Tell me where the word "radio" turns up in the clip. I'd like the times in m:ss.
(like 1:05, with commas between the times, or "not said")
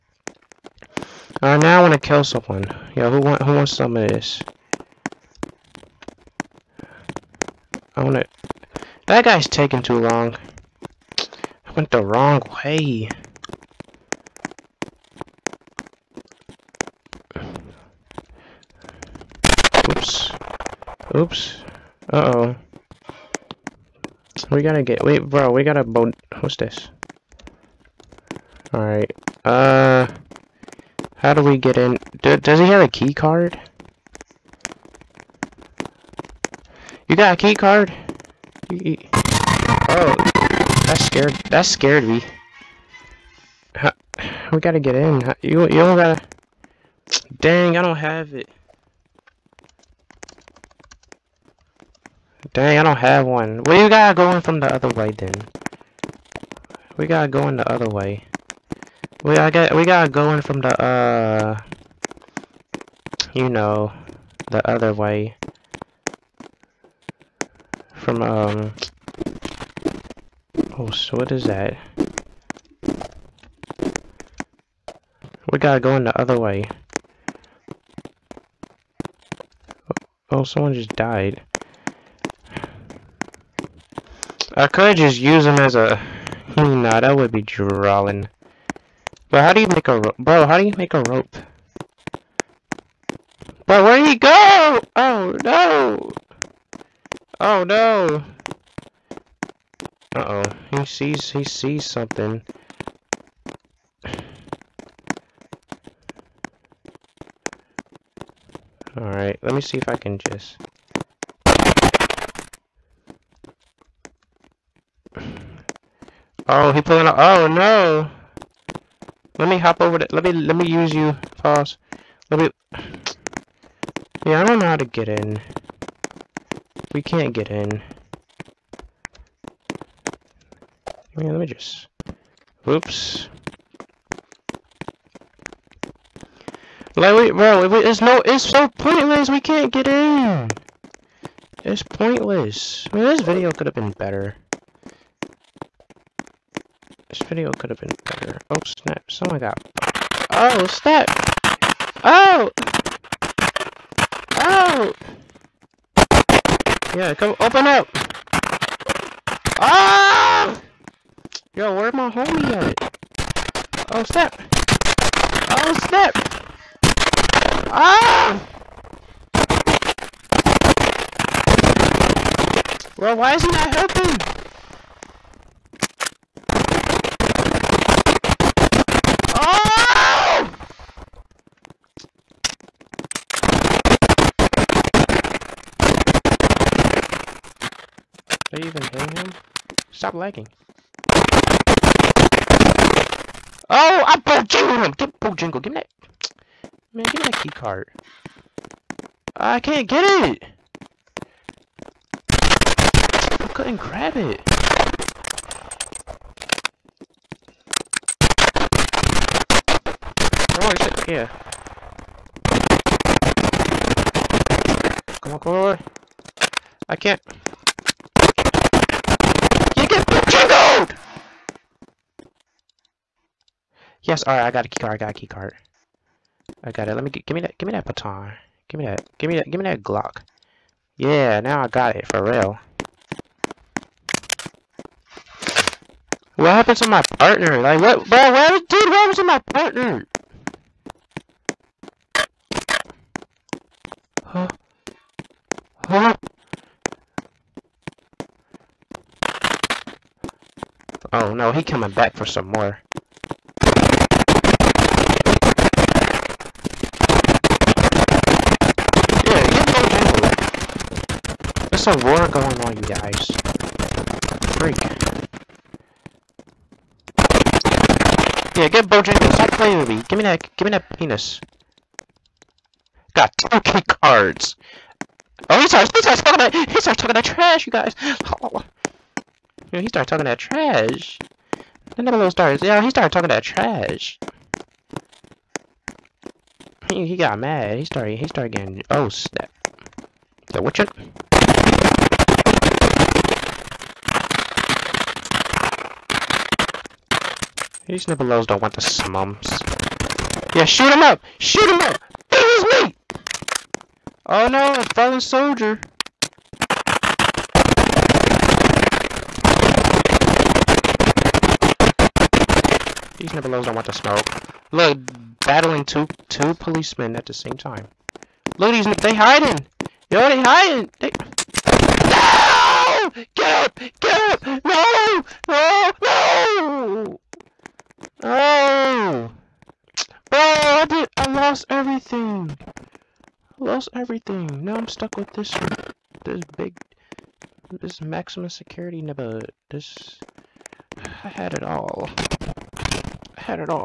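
not said.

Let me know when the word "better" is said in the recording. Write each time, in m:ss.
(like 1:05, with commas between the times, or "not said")
2:23, 2:28.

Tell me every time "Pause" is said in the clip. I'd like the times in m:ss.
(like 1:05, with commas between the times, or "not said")
2:01.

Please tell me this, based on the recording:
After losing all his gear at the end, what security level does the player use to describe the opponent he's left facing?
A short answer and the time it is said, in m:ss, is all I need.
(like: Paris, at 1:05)
maximum security, at 5:38.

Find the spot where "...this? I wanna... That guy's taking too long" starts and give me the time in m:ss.
0:04.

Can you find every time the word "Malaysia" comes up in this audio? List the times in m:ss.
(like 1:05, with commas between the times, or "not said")
not said.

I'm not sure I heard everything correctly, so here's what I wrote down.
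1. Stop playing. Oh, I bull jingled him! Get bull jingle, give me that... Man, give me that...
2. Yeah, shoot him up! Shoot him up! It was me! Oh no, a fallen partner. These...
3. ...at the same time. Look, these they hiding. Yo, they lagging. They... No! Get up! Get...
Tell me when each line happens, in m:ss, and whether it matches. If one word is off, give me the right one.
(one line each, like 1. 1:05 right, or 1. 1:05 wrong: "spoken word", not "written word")
1. 3:09 wrong: "lagging", not "playing"
2. 5:00 wrong: "soldier", not "partner"
3. 5:17 wrong: "hiding", not "lagging".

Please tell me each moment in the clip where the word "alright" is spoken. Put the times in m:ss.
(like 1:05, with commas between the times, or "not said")
0:01, 0:28, 1:48, 3:44.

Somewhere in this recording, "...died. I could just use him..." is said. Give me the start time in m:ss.
1:20.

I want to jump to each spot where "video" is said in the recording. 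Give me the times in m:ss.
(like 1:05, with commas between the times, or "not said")
2:23, 2:27.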